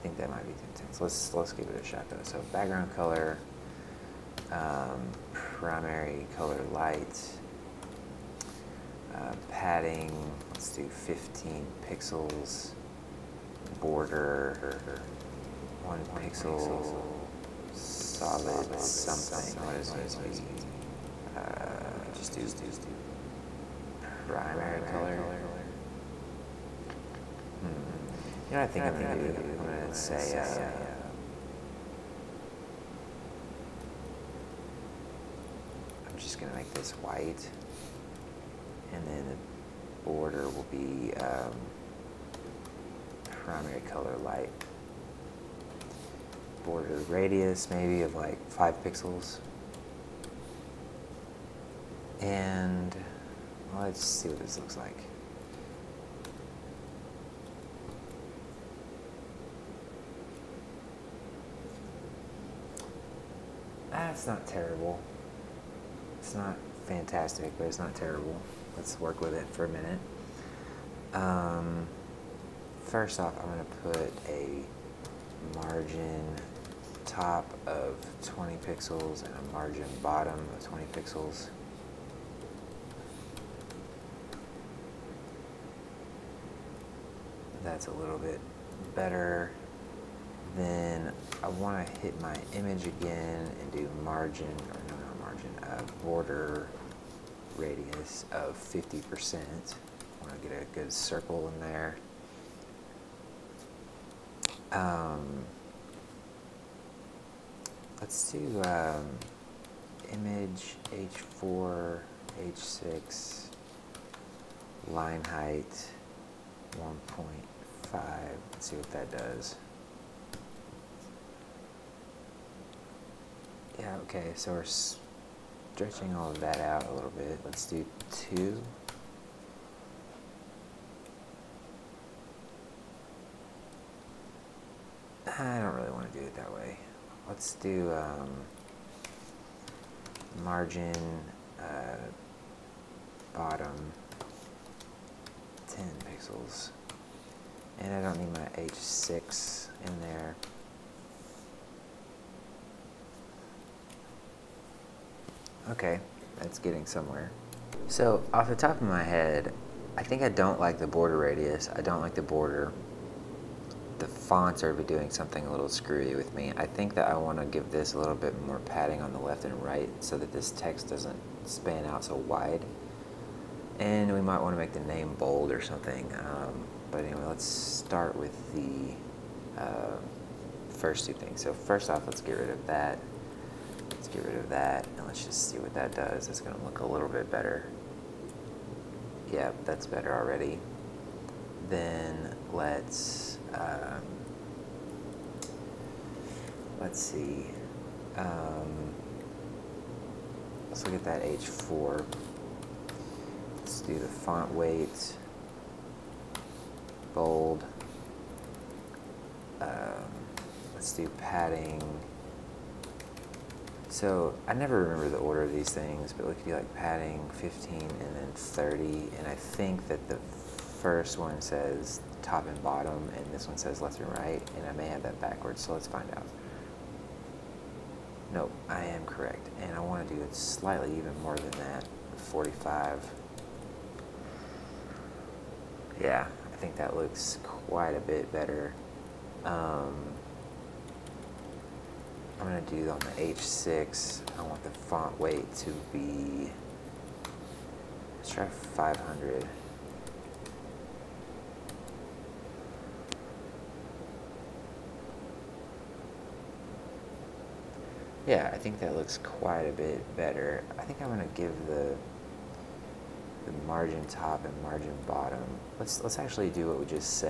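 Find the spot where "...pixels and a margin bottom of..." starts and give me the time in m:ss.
1:18.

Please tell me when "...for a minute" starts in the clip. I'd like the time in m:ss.
1:09.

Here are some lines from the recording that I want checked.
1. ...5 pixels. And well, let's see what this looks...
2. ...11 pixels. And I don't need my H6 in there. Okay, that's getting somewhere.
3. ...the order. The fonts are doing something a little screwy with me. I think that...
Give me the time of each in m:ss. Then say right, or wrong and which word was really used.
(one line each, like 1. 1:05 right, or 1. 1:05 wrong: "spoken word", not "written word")
1. 0:48 right
2. 2:25 wrong: "10", not "11"
3. 2:42 wrong: "border", not "order".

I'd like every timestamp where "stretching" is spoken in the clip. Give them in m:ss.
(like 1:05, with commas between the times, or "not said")
2:04.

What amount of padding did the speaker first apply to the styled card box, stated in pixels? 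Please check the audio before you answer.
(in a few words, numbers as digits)
15 pixels.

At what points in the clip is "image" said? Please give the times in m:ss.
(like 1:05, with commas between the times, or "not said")
1:32, 1:50.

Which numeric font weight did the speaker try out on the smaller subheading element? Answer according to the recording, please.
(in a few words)
500.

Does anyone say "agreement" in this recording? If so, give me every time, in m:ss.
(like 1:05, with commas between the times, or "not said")
not said.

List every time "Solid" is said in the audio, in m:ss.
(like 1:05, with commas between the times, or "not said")
0:17.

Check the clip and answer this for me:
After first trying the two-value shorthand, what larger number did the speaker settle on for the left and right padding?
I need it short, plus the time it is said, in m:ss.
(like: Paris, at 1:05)
45, at 3:52.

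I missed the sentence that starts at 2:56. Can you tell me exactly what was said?
Um, but anyway, let's start with the uh, first two things.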